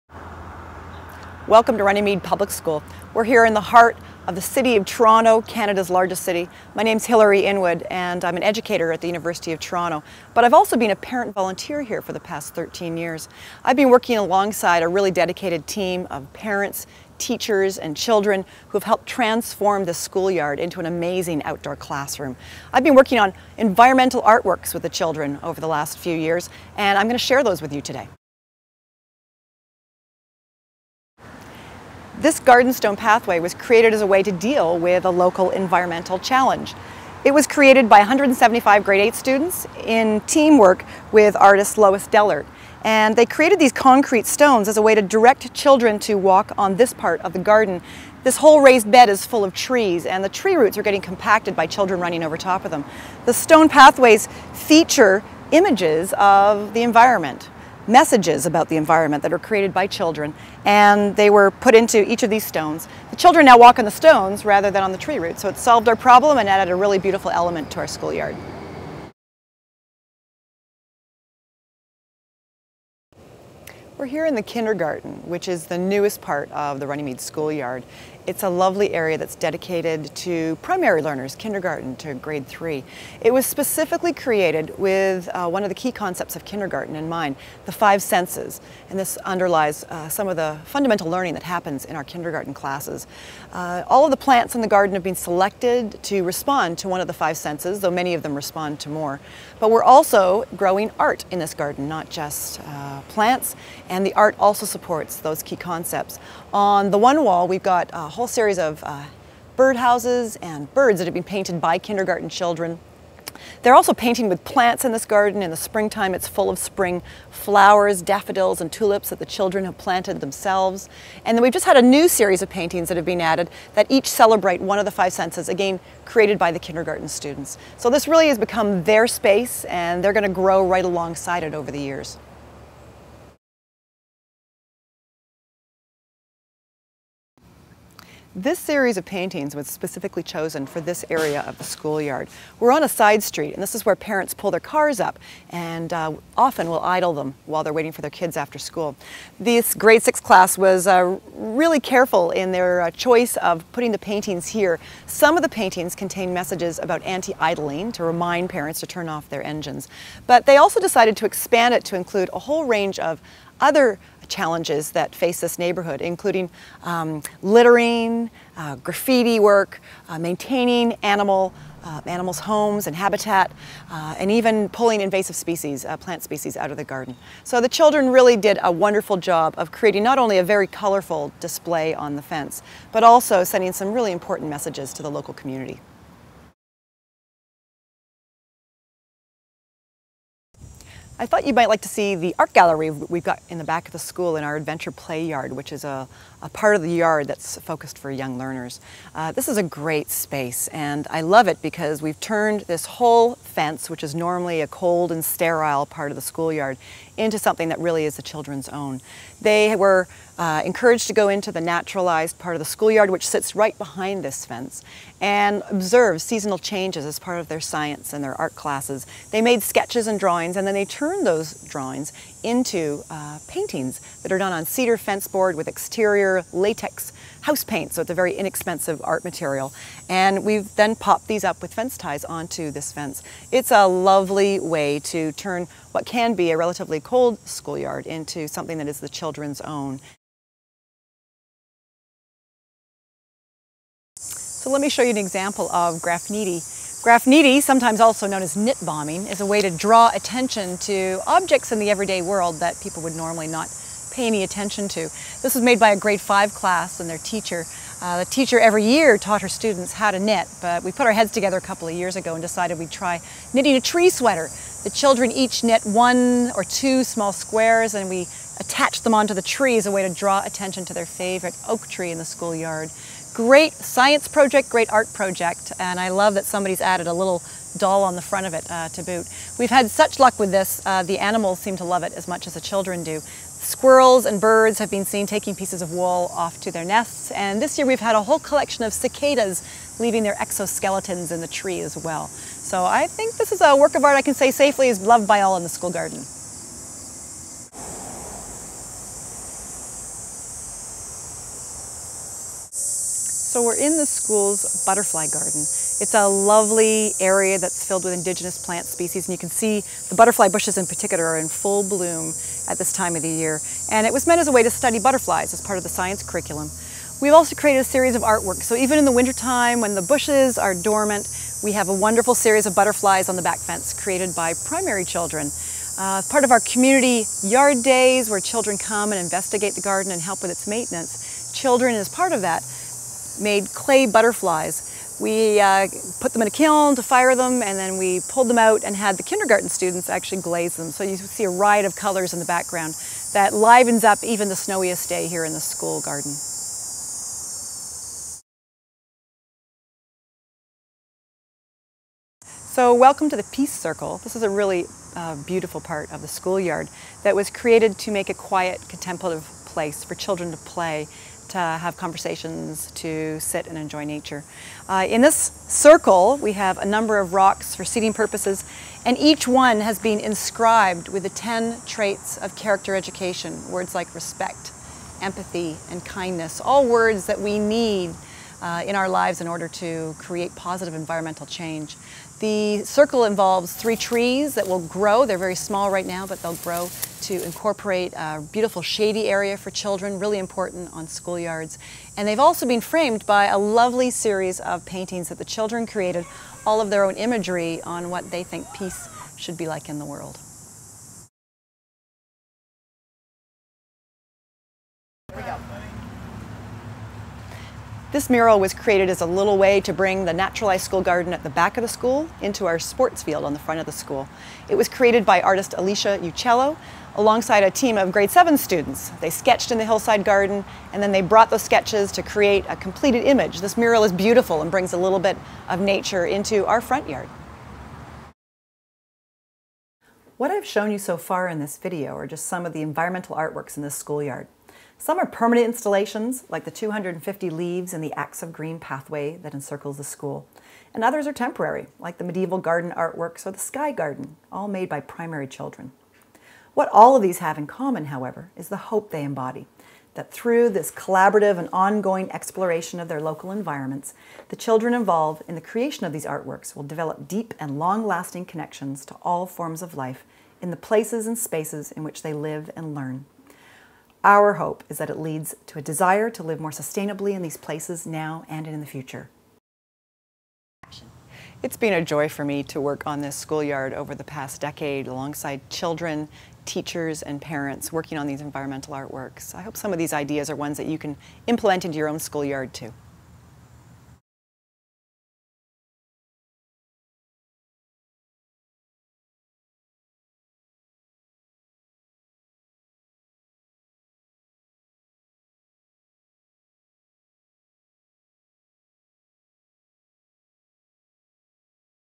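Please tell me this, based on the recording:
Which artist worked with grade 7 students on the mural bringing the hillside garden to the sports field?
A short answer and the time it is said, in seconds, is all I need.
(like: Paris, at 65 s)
Alicia Uccello, at 415 s.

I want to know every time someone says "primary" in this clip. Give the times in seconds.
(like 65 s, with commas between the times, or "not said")
80 s, 324 s, 444 s.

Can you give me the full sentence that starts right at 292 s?
So I think this is a work of art I can say safely is loved by all in the school garden.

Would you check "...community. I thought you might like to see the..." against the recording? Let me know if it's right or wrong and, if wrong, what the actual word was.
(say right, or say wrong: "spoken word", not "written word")
right.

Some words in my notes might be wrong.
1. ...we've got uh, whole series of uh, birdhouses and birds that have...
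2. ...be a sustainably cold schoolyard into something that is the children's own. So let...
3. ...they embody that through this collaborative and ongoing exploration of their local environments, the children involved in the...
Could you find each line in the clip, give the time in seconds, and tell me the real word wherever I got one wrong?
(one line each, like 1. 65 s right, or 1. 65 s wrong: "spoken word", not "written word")
1. 107 s right
2. 236 s wrong: "relatively", not "sustainably"
3. 449 s right.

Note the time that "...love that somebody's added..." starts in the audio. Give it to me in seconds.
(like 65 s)
276 s.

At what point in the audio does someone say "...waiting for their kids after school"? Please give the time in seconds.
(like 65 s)
147 s.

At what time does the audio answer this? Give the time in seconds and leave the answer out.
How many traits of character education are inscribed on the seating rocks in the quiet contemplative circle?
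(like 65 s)
371 s.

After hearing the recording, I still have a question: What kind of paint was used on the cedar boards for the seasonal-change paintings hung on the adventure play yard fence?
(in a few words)
Exterior latex house paint.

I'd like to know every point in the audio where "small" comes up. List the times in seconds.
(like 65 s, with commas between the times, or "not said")
267 s, 385 s.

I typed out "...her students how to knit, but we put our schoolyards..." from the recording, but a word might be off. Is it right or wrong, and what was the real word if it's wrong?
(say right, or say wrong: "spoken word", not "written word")
wrong: "heads", not "schoolyards".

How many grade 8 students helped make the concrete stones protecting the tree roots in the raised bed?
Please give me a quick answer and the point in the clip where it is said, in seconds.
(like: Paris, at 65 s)
175, at 37 s.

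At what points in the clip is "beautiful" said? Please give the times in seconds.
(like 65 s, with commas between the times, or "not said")
66 s, 355 s, 388 s, 424 s.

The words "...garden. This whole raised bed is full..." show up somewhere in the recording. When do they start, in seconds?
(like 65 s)
47 s.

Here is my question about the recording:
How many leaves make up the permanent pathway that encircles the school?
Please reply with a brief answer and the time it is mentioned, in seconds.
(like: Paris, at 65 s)
250, at 436 s.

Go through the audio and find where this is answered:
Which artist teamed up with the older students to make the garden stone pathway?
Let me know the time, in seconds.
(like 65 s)
41 s.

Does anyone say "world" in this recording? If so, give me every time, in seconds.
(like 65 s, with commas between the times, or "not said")
252 s, 400 s.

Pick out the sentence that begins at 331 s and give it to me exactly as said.
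Children is part of that made clay butterflies.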